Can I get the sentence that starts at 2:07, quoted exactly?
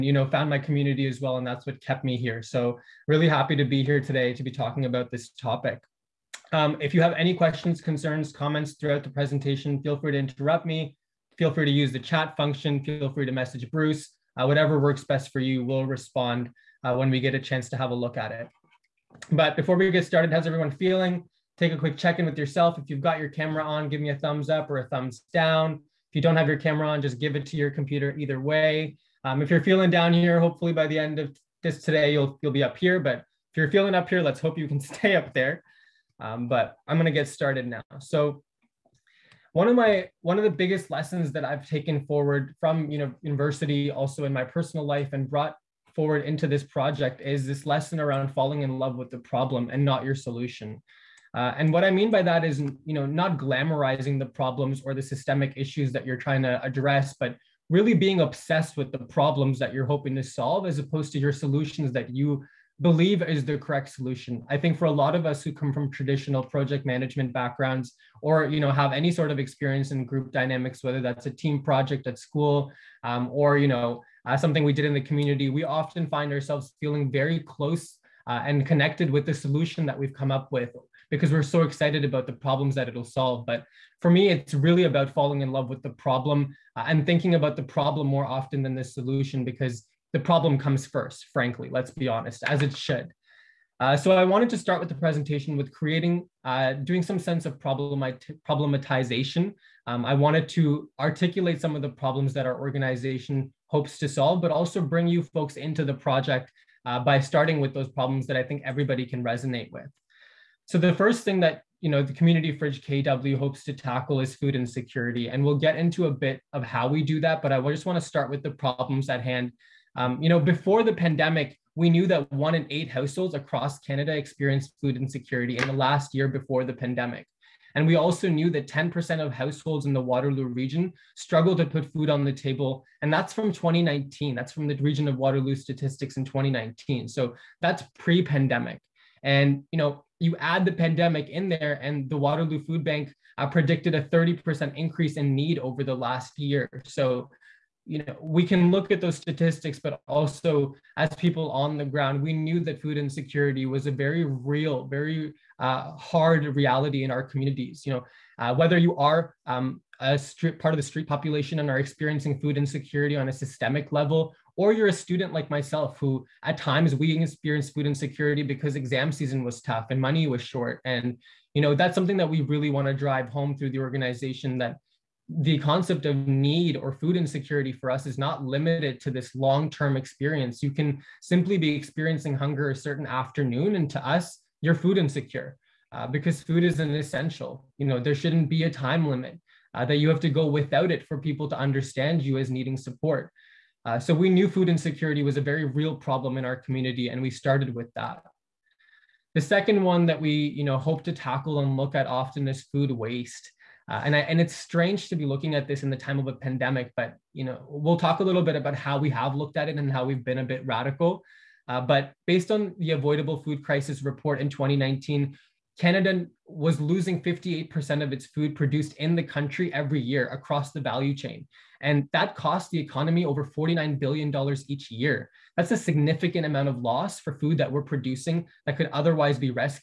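And we also knew that 10% of households in the Waterloo region struggle to put food on the table.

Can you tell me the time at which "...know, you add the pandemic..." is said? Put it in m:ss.
2:19.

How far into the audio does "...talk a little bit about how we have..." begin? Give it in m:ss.
3:27.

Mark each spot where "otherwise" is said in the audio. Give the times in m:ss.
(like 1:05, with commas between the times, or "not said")
3:48.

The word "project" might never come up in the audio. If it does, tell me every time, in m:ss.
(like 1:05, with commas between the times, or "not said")
0:46, 1:06, 1:11, 1:45.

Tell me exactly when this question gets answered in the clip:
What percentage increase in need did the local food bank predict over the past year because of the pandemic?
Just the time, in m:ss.
2:24.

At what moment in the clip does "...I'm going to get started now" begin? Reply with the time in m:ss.
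0:36.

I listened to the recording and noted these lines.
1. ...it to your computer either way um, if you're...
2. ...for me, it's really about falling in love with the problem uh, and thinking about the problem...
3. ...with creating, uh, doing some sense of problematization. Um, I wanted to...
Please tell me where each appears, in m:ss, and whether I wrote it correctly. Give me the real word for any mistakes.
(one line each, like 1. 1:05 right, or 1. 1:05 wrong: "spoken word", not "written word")
1. 0:27 right
2. 1:24 right
3. 1:35 right.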